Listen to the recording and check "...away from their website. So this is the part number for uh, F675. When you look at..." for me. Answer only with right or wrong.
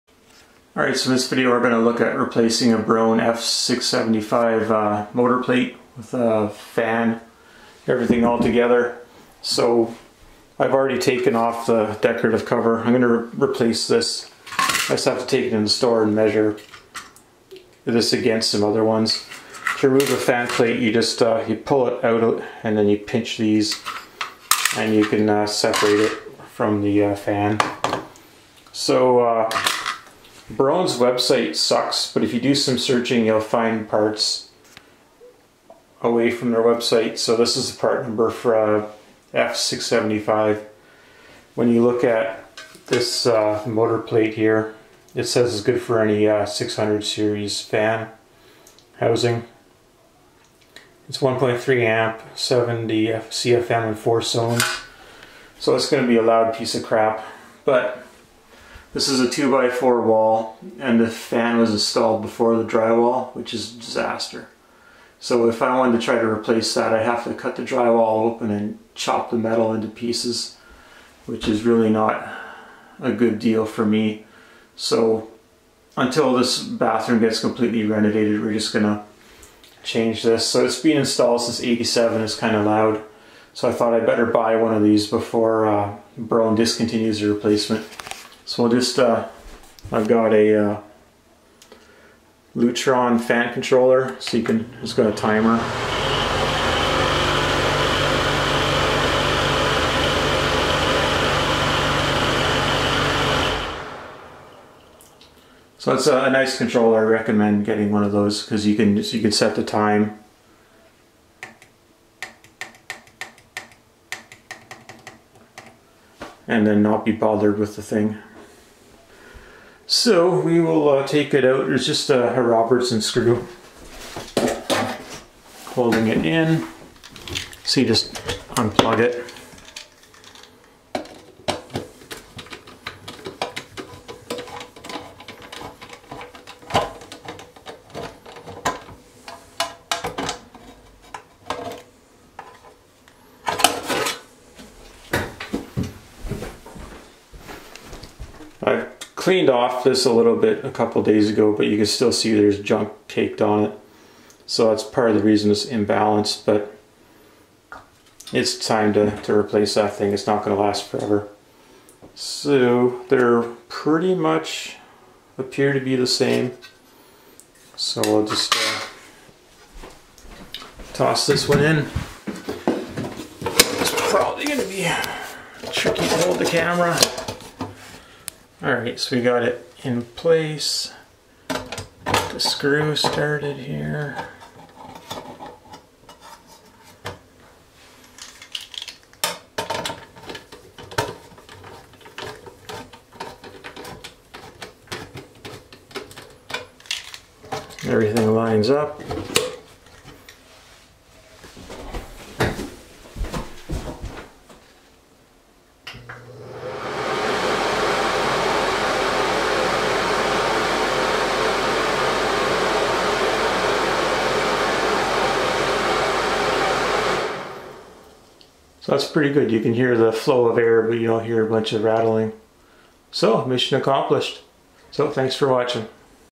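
right.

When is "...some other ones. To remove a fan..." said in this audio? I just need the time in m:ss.
0:18.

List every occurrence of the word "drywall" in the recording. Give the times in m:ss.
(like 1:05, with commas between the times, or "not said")
1:02, 1:07.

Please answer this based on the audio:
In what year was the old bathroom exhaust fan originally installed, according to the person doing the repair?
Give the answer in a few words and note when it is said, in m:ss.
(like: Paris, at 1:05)
1987, at 1:21.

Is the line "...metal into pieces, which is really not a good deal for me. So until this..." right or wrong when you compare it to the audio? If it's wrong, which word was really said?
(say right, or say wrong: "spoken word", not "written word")
right.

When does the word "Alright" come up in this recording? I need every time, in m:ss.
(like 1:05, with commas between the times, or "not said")
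0:00, 2:58.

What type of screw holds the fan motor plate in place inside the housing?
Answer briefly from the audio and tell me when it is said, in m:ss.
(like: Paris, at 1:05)
Robertson, at 2:02.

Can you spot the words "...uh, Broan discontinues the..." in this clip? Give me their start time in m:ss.
1:25.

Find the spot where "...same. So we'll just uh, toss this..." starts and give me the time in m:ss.
2:46.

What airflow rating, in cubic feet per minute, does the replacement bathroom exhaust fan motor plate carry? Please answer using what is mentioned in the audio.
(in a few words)
70 CFM.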